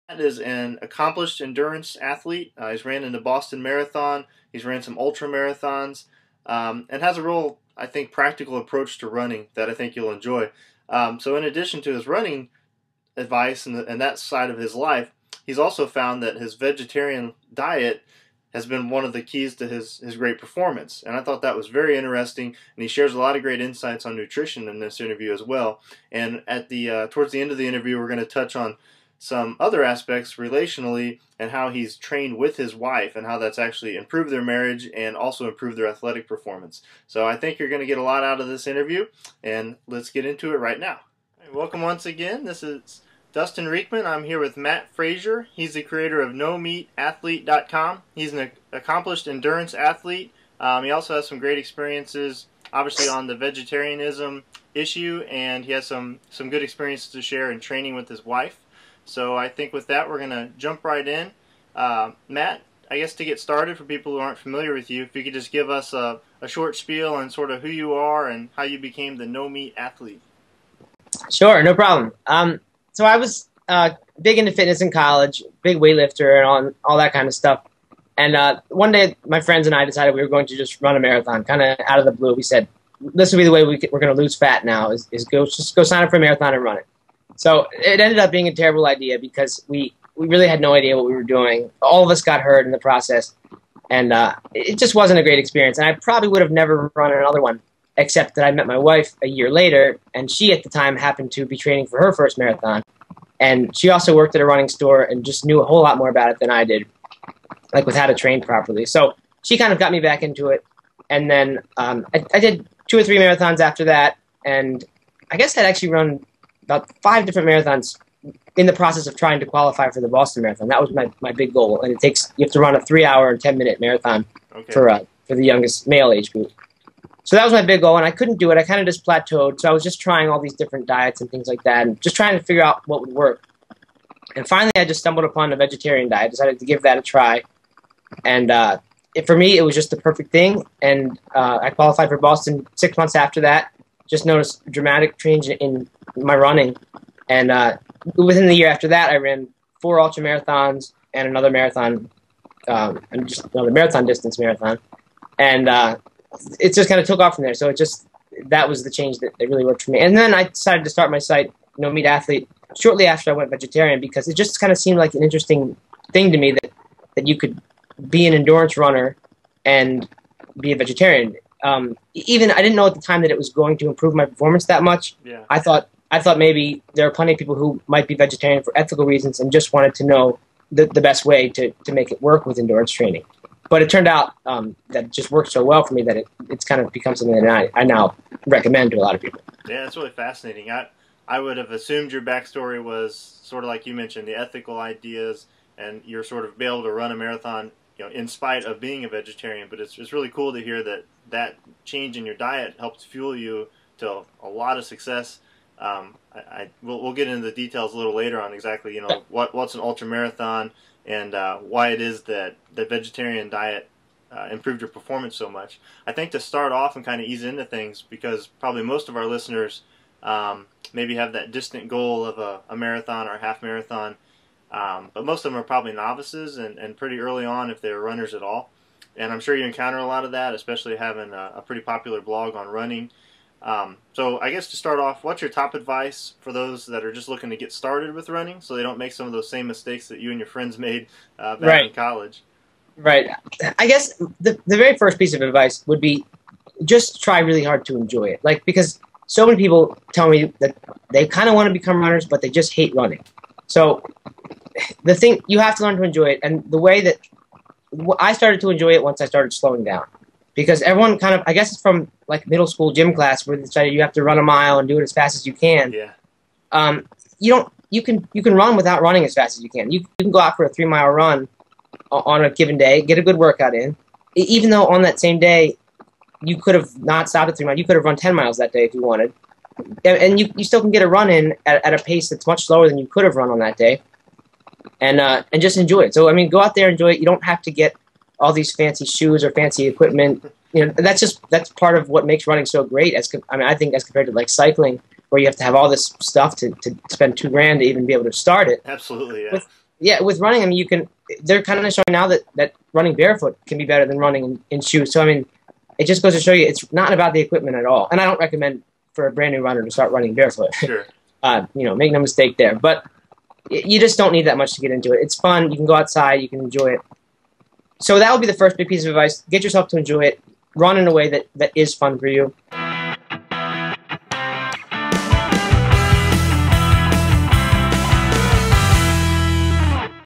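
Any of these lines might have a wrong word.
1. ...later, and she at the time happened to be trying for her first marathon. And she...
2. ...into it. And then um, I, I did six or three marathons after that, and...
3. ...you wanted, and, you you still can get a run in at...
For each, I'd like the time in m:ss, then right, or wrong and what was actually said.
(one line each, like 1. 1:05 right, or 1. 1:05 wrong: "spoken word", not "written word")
1. 1:39 wrong: "training", not "trying"
2. 1:50 wrong: "two", not "six"
3. 4:38 right.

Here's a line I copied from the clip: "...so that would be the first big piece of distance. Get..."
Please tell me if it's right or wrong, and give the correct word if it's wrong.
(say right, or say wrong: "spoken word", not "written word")
wrong: "advice", not "distance".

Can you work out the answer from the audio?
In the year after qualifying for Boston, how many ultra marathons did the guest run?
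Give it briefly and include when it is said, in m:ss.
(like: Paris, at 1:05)
4, at 2:29.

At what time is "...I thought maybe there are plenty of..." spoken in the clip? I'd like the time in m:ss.
2:56.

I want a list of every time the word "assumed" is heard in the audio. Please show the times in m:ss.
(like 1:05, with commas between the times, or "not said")
3:11.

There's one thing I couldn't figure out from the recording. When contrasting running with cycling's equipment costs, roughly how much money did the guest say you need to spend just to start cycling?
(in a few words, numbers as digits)
2 grand.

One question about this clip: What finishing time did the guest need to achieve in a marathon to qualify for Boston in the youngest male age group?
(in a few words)
3 hours 10 minutes.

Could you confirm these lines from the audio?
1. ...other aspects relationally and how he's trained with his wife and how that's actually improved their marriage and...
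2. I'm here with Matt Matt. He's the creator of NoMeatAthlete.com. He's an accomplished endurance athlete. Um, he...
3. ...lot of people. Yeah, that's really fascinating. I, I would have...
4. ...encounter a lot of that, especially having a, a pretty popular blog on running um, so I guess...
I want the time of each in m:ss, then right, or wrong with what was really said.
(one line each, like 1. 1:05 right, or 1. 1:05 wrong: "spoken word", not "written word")
1. 0:29 right
2. 0:44 wrong: "Frazier", not "Matt"
3. 3:08 right
4. 3:49 right.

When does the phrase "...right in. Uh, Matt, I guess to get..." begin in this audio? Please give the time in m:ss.
1:00.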